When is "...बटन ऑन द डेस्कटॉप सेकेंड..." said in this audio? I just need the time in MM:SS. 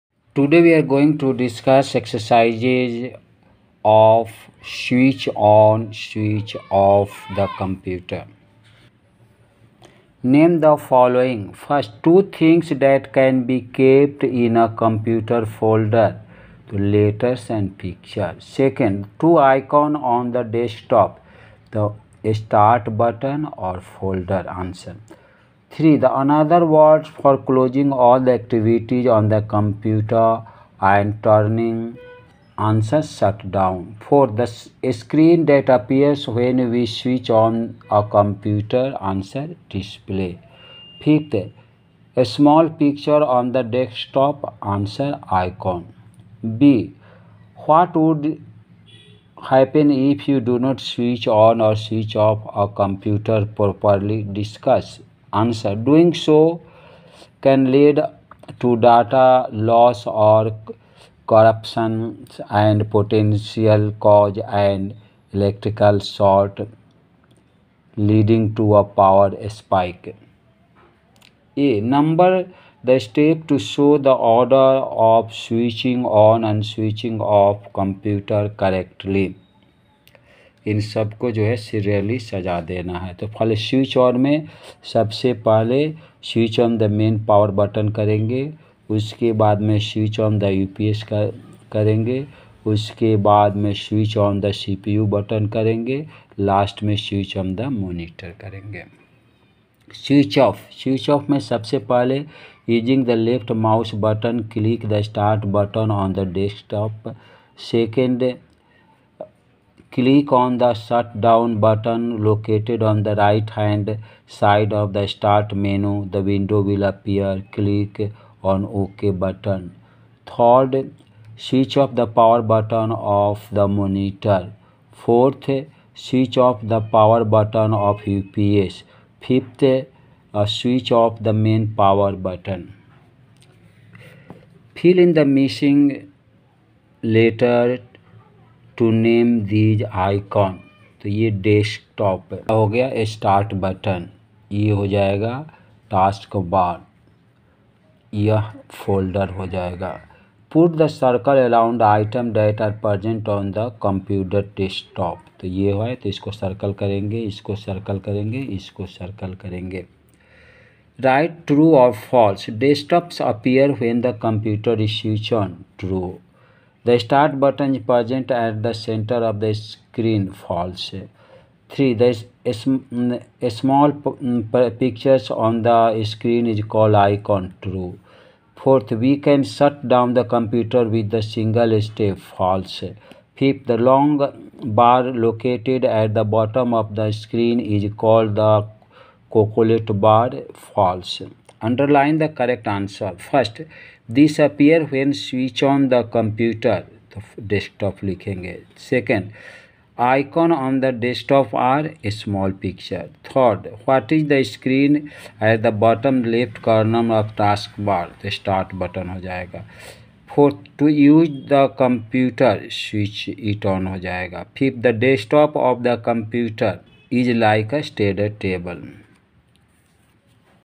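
01:45.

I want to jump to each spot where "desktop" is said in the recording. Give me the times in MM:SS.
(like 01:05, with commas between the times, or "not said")
00:20, 00:43.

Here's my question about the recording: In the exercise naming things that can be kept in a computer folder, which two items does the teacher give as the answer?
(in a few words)
Letters and pictures.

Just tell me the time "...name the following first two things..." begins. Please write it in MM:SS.
00:10.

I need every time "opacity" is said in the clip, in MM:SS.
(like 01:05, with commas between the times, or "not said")
not said.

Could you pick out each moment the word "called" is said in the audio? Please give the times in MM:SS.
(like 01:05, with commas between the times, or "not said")
02:56, 03:07.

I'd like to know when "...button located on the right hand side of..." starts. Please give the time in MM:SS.
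01:51.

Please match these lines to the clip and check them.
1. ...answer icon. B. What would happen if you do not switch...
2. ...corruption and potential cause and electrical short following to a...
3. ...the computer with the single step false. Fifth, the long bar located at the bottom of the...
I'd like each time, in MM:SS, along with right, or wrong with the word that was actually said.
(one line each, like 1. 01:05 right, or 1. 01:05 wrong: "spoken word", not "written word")
1. 00:44 right
2. 01:01 wrong: "leading", not "following"
3. 03:00 right.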